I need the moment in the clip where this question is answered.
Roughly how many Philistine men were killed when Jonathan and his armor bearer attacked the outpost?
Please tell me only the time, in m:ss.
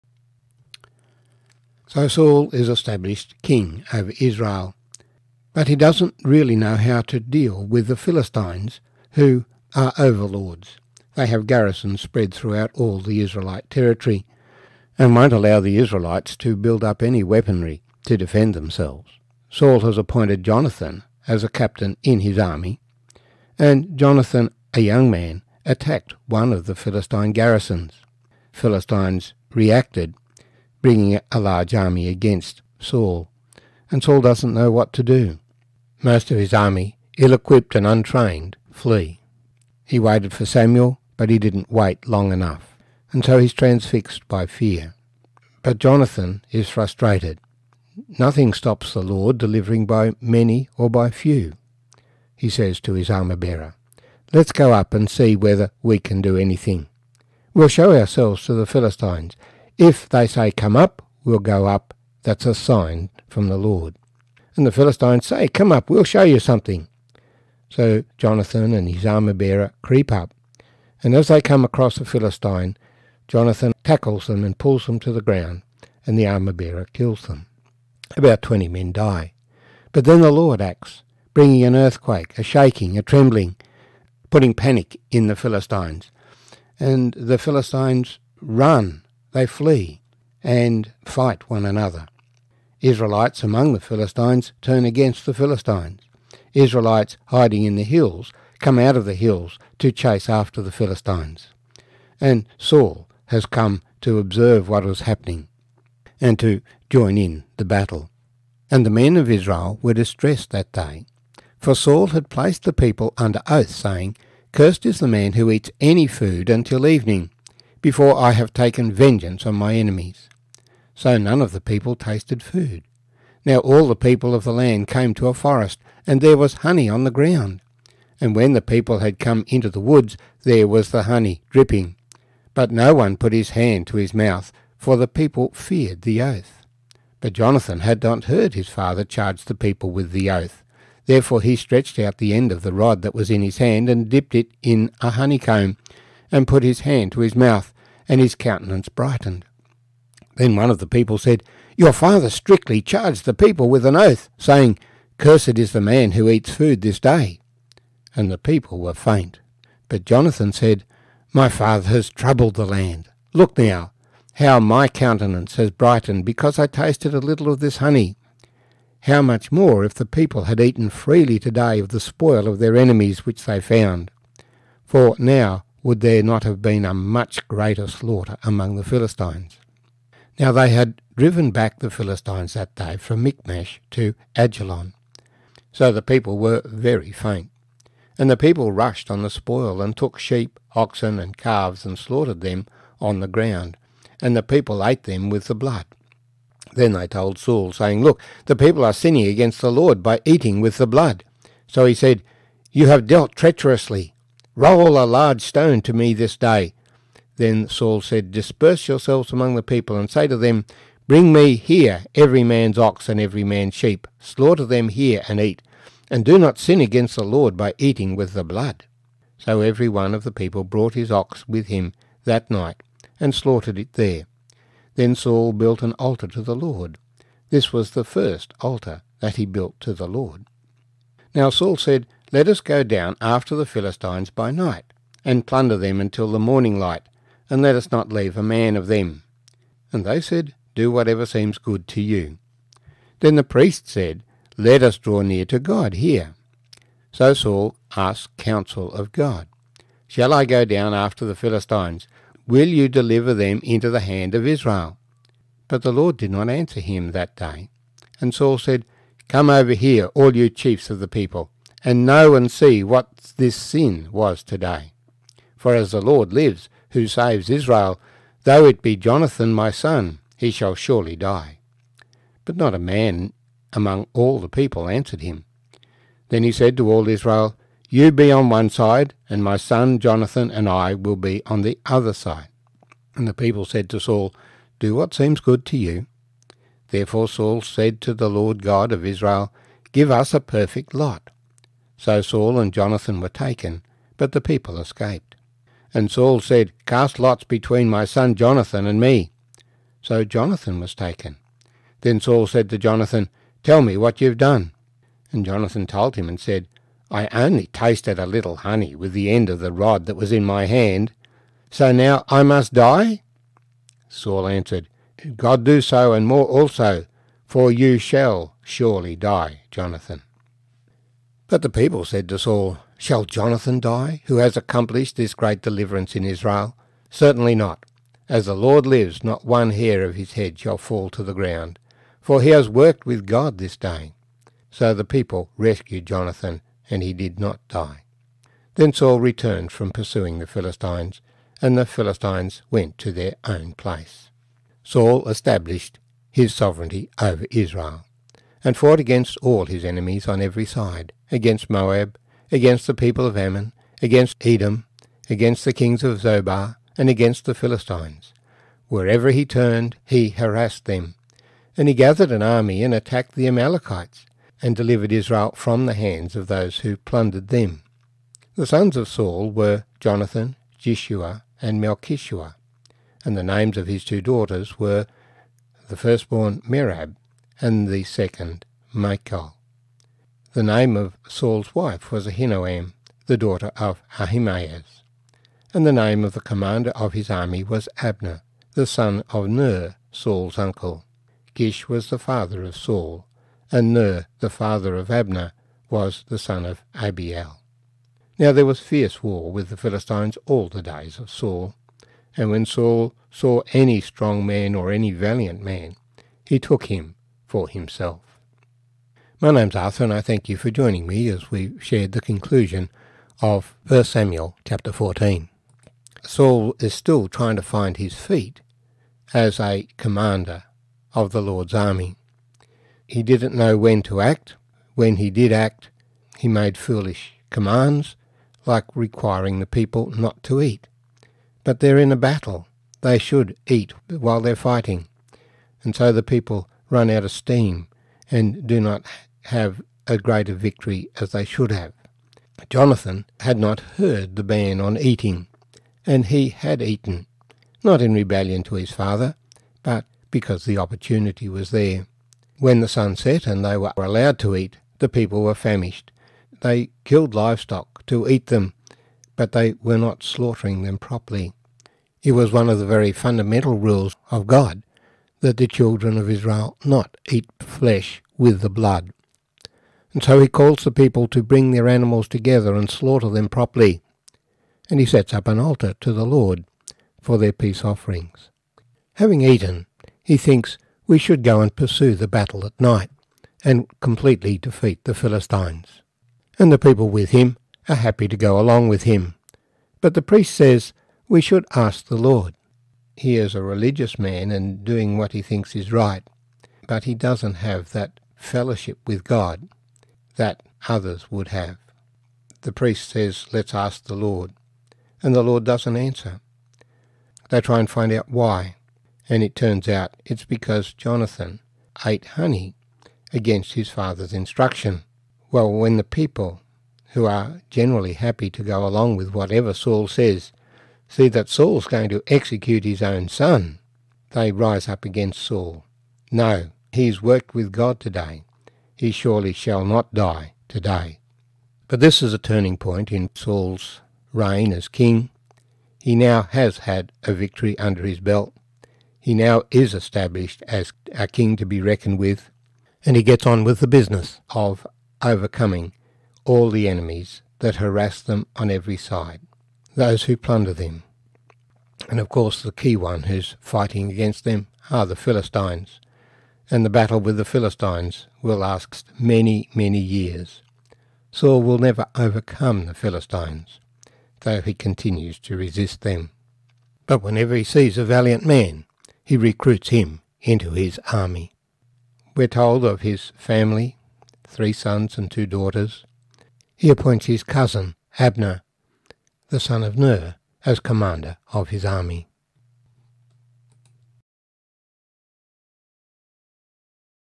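1:18.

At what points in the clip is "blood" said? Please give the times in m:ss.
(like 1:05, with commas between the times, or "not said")
3:15, 3:20, 3:38, 7:48.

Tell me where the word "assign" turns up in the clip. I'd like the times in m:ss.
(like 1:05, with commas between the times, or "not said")
not said.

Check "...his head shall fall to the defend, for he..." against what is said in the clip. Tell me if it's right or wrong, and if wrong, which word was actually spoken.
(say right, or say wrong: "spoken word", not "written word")
wrong: "ground", not "defend".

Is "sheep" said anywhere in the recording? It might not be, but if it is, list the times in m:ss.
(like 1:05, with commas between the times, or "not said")
3:10, 3:33.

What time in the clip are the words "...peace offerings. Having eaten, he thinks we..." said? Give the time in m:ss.
7:57.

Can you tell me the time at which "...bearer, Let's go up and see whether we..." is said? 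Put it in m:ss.
0:53.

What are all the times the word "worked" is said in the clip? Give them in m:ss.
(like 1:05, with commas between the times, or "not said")
5:32, 8:47.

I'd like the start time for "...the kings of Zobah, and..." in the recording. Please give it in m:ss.
5:55.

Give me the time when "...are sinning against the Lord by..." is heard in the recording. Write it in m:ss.
3:18.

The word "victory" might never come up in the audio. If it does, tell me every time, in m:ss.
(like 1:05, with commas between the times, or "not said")
7:20, 8:57.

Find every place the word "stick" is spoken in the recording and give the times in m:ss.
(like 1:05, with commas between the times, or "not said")
not said.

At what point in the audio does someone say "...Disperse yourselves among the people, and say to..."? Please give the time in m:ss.
3:28.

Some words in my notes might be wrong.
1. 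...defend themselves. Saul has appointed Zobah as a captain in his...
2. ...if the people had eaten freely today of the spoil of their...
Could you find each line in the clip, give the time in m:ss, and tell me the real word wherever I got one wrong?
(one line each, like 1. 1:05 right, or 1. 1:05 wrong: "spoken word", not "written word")
1. 0:18 wrong: "Jonathan", not "Zobah"
2. 2:49 right.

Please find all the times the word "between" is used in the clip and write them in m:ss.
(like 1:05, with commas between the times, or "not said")
4:57.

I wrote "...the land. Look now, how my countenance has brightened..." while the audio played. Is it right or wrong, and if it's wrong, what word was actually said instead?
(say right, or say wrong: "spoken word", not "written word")
right.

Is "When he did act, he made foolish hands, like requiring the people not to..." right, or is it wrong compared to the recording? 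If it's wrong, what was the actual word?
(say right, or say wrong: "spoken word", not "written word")
wrong: "commands", not "hands".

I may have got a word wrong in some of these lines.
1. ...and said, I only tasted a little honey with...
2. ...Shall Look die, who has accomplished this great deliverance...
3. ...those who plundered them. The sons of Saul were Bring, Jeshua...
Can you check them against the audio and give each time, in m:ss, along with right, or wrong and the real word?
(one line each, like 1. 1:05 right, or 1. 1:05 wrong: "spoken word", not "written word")
1. 5:06 right
2. 5:22 wrong: "Jonathan", not "Look"
3. 6:06 wrong: "Jonathan", not "Bring".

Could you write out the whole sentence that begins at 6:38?
Now there was fierce war with the Philistines all the days of Saul.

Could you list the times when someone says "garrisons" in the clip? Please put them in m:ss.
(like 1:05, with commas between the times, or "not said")
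0:11, 0:27.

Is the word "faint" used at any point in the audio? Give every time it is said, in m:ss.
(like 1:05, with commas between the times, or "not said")
2:38, 3:07.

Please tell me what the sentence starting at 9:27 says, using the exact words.
But whenever he sees a valiant man, he recruits him into his army.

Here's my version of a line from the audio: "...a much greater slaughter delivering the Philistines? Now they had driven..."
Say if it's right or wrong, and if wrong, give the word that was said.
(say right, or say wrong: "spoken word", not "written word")
wrong: "among", not "delivering".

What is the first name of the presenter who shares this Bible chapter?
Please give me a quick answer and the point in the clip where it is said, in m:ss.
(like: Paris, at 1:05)
Arthur, at 6:49.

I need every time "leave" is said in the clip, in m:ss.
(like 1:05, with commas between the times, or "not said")
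3:58.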